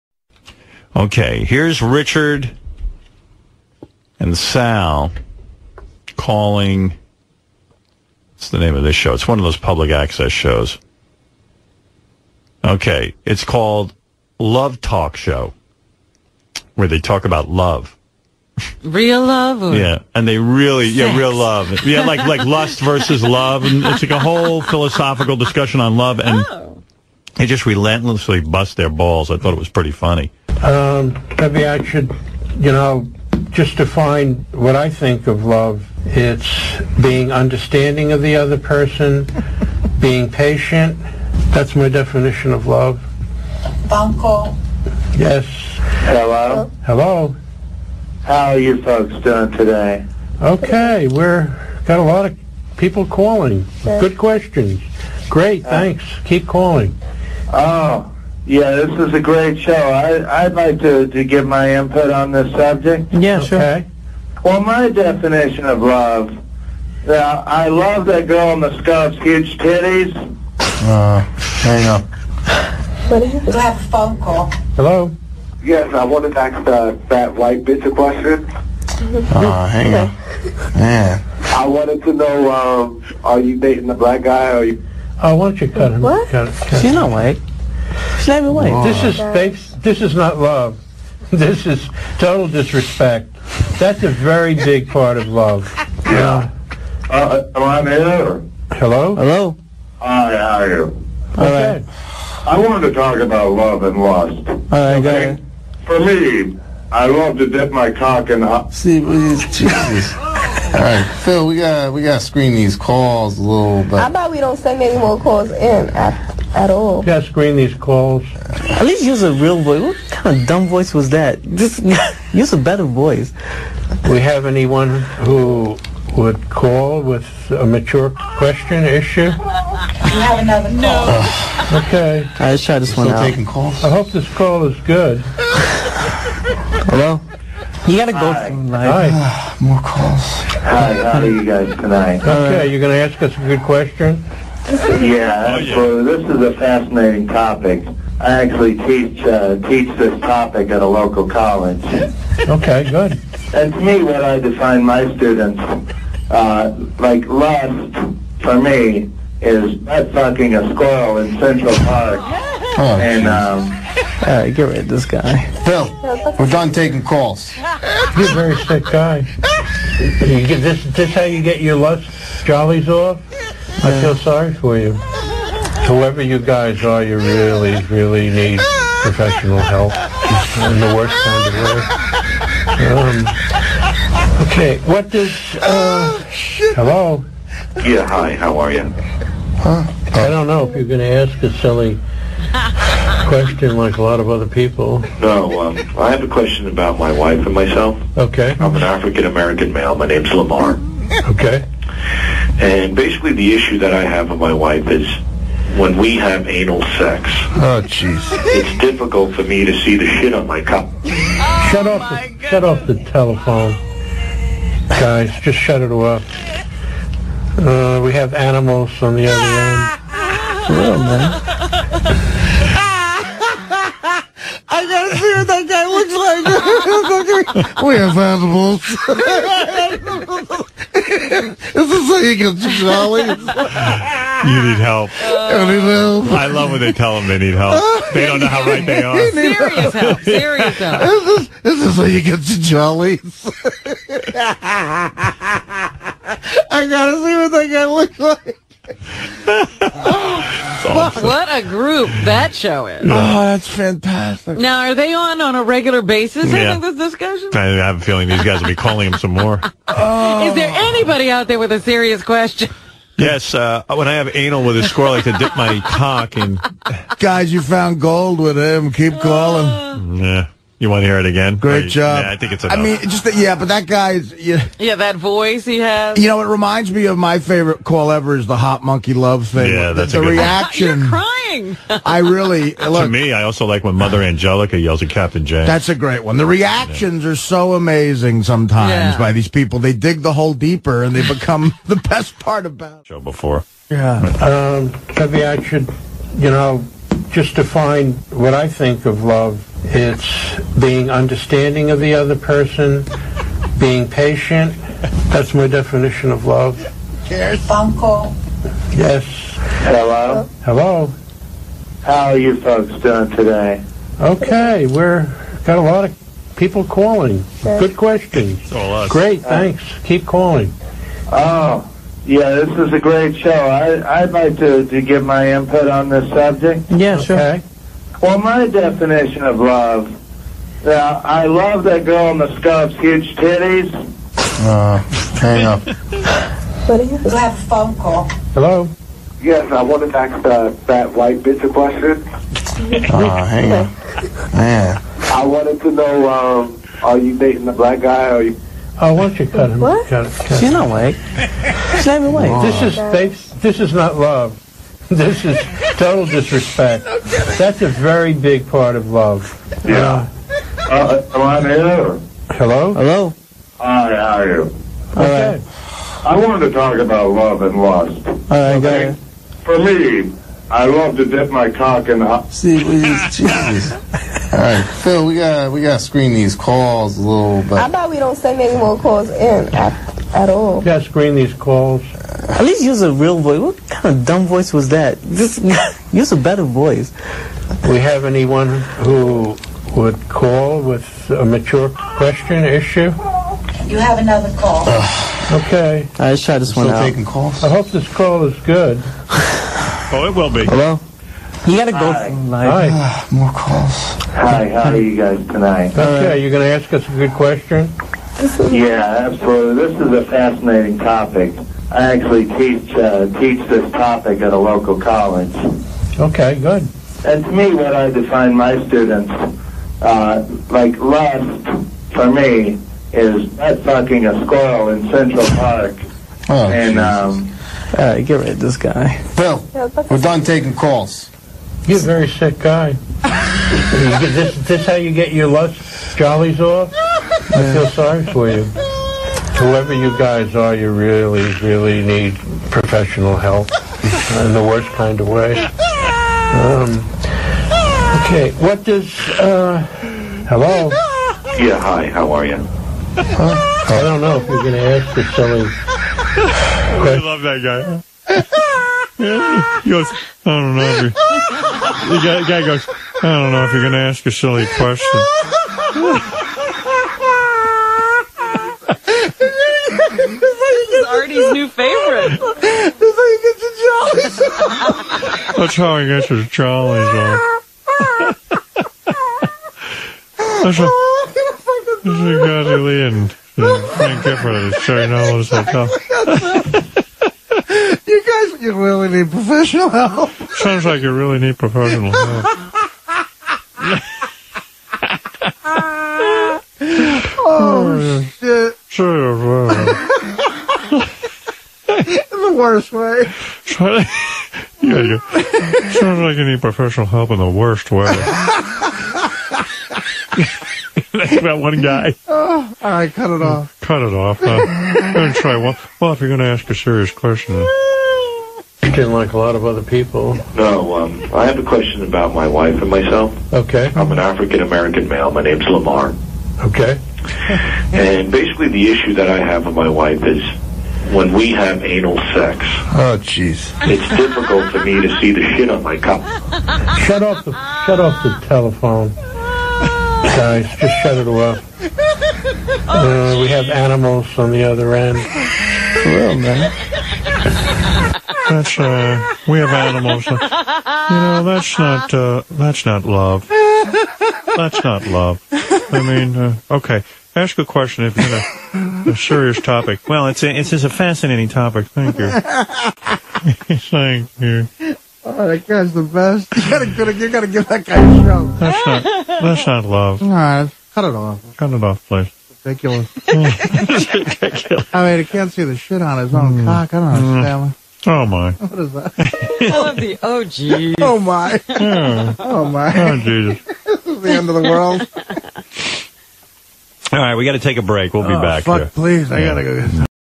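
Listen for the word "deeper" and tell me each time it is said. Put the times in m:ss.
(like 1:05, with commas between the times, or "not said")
4:50.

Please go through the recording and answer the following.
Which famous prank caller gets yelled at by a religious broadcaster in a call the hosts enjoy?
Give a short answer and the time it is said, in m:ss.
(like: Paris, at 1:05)
Captain Janks, at 4:45.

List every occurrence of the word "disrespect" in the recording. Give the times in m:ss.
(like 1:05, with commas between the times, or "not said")
1:32, 5:56.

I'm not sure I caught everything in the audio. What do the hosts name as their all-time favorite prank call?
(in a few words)
the hot monkey love thing.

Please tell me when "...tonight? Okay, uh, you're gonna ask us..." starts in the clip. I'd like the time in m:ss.
6:45.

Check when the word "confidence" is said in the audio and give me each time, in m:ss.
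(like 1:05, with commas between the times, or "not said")
not said.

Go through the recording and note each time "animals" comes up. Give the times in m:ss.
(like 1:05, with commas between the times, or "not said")
3:38, 3:50, 9:03, 9:09.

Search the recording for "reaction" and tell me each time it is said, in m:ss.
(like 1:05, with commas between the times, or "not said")
4:40, 4:46.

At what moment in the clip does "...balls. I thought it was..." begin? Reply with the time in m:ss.
0:28.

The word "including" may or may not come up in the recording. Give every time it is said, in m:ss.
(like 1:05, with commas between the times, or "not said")
not said.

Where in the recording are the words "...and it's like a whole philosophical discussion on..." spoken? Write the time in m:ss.
0:23.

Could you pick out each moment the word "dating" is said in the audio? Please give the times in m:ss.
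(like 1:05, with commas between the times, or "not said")
1:23, 5:47.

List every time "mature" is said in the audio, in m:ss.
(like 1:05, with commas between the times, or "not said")
2:07, 6:31.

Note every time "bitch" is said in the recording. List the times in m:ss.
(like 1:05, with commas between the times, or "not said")
1:17, 5:41.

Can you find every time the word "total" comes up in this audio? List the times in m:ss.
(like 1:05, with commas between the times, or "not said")
1:32, 5:55.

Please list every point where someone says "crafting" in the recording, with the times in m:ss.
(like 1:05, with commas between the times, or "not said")
not said.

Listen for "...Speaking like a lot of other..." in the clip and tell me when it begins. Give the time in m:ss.
8:38.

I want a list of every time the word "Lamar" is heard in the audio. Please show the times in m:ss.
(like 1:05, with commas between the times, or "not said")
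3:20, 8:45.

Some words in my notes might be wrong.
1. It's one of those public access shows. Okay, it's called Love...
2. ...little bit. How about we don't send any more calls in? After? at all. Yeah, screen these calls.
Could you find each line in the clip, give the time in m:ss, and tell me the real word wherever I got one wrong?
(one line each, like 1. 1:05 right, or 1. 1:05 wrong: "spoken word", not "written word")
1. 0:09 right
2. 1:53 right.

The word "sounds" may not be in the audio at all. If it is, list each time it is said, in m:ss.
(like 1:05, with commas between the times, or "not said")
8:10, 8:25.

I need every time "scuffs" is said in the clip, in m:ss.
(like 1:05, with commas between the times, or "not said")
1:08, 5:32.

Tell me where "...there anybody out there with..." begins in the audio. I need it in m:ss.
4:20.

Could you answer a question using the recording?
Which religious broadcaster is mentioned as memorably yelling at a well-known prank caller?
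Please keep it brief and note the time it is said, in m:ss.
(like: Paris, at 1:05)
Mother Angelica, at 4:43.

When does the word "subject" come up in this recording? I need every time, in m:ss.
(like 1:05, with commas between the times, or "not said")
1:02, 5:26.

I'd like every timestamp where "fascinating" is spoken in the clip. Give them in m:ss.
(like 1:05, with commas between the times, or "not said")
2:26, 6:50, 9:20.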